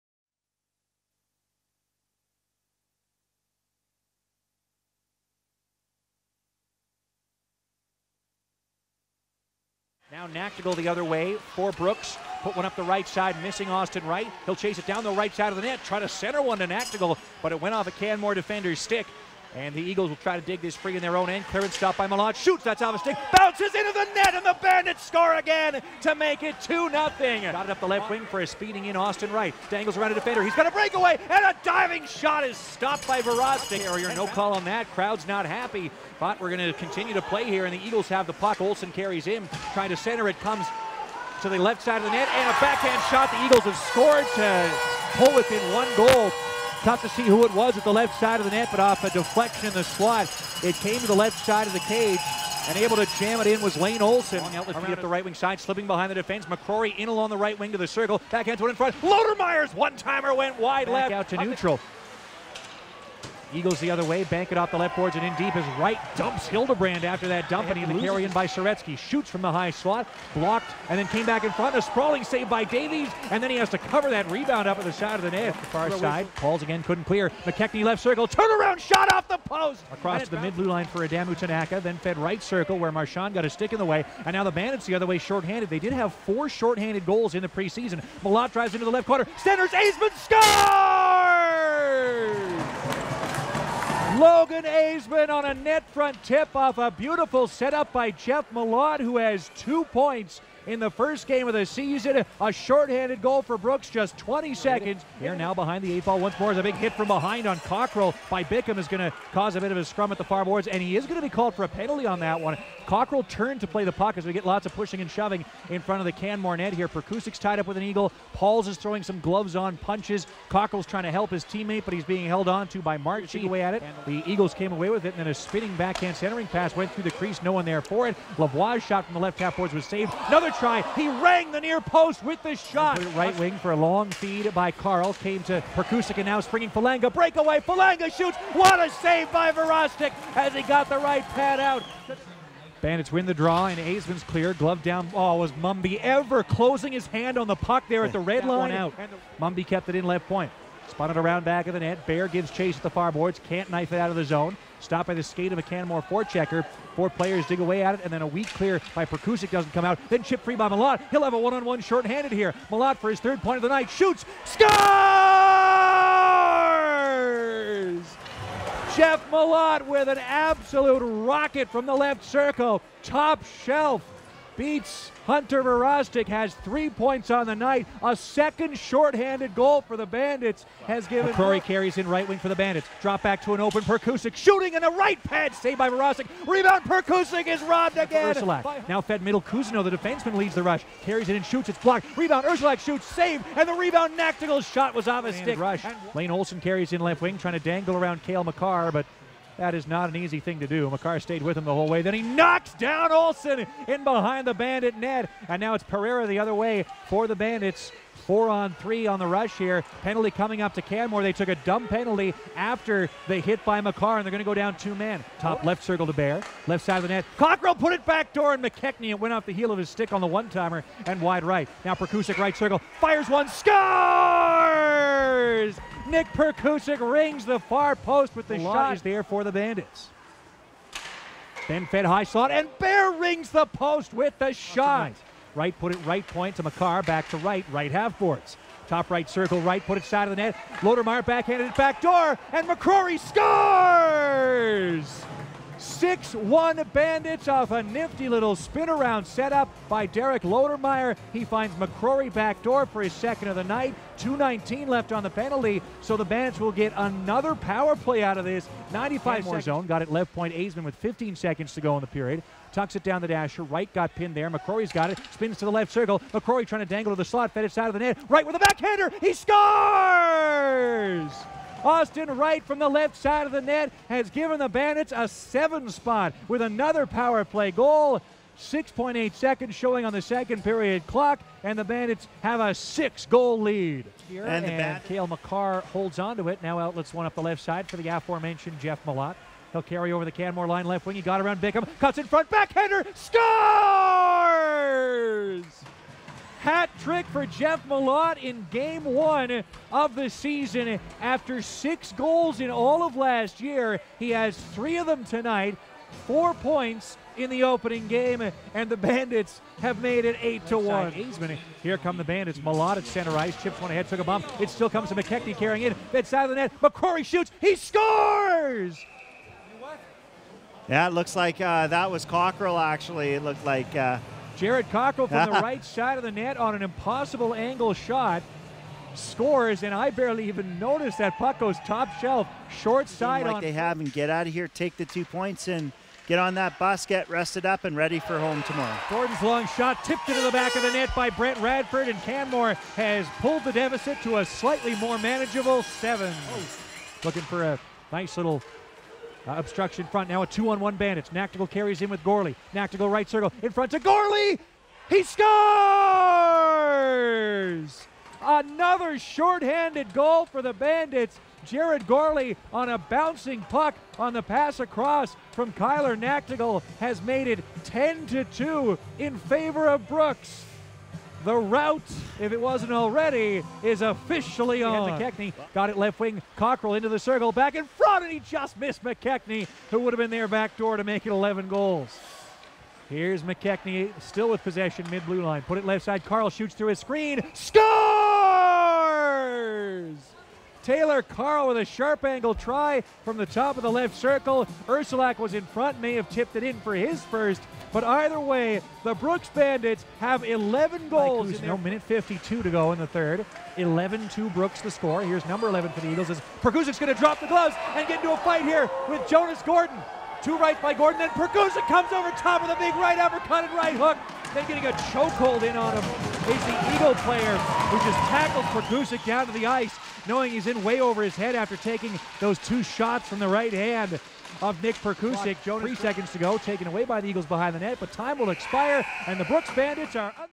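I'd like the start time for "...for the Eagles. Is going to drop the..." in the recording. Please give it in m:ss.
6:45.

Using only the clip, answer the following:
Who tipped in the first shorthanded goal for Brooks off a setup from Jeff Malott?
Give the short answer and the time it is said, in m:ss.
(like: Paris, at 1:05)
Logan Aisman, at 1:34.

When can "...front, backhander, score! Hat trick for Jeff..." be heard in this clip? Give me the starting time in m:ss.
4:52.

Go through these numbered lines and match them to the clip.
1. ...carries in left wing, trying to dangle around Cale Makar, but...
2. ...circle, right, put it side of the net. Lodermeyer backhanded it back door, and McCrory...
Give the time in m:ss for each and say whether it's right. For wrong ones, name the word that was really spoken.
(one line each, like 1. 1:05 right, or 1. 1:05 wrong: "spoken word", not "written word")
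1. 3:16 right
2. 3:59 right.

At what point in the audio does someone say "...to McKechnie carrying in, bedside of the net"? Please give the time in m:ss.
5:15.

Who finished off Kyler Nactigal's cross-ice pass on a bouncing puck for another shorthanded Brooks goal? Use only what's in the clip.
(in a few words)
Jared Gorley.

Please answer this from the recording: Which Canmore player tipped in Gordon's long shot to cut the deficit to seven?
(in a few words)
Brent Radford.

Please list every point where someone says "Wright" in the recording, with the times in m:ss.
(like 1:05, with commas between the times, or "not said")
0:14, 0:29, 4:32.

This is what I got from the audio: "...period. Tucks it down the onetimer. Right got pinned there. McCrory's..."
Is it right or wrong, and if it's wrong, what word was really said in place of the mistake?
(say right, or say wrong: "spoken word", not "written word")
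wrong: "dasher", not "onetimer".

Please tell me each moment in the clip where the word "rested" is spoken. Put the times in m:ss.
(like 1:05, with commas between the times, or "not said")
5:37.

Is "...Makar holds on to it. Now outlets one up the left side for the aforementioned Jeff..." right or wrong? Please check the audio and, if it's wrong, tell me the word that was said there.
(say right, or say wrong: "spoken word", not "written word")
right.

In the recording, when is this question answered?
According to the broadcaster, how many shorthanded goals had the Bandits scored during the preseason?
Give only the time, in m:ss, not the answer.
1:26.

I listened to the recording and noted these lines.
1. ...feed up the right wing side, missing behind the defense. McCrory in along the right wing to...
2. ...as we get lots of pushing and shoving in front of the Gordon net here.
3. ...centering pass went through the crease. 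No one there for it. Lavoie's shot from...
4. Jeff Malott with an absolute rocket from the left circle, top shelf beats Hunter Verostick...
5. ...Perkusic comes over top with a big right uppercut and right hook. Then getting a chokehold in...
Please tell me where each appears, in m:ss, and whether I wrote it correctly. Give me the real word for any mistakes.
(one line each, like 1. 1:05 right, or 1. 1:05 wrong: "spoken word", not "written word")
1. 0:54 wrong: "slipping", not "missing"
2. 1:54 wrong: "Canmore", not "Gordon"
3. 2:06 right
4. 2:48 right
5. 6:51 right.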